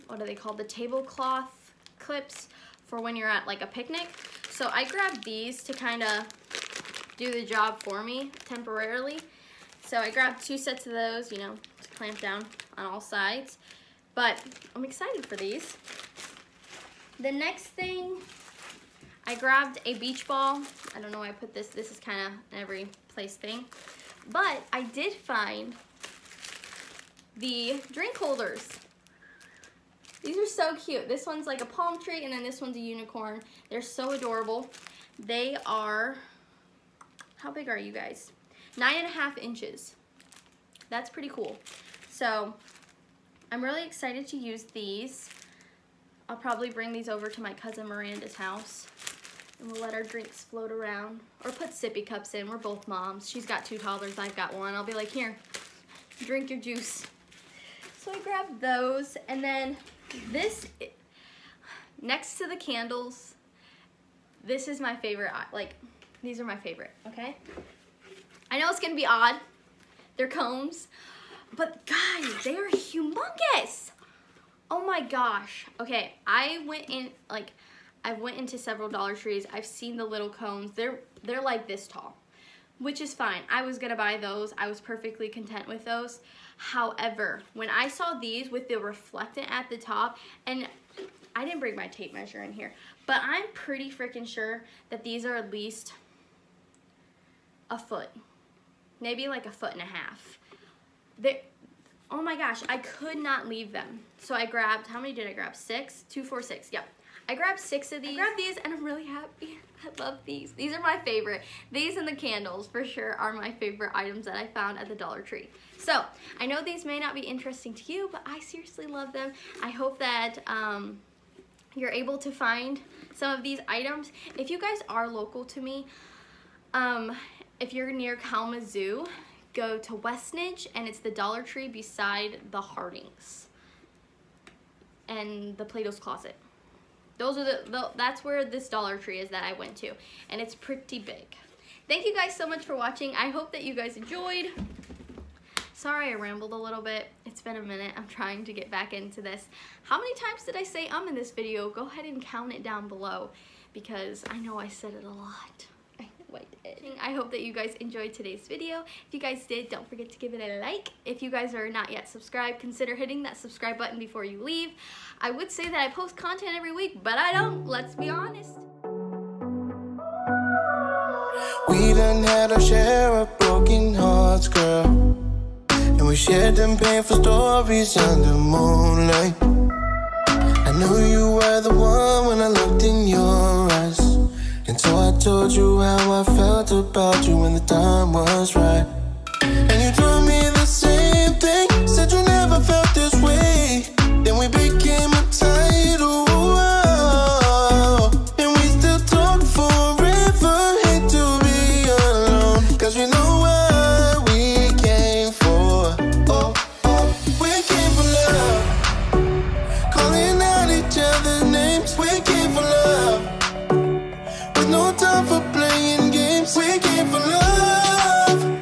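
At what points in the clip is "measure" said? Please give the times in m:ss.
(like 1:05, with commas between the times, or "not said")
1:32.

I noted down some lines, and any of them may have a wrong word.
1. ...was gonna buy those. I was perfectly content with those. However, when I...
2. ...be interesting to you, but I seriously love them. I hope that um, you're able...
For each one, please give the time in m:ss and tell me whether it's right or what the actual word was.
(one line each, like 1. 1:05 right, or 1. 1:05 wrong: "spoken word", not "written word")
1. 1:23 right
2. 1:57 right.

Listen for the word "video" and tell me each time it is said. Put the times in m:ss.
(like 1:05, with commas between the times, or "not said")
2:31, 2:38.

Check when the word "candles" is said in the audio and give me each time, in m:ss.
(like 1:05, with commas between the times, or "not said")
1:02, 1:52.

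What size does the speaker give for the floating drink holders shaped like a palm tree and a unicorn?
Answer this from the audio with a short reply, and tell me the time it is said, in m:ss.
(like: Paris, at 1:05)
9.5 inches, at 0:38.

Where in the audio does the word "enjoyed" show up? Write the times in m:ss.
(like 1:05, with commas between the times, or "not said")
2:23, 2:37.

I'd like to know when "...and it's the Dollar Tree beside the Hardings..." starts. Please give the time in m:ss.
2:10.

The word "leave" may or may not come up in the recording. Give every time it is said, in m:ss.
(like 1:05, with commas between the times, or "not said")
1:43, 2:44.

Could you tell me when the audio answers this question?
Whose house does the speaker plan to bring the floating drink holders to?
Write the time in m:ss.
0:47.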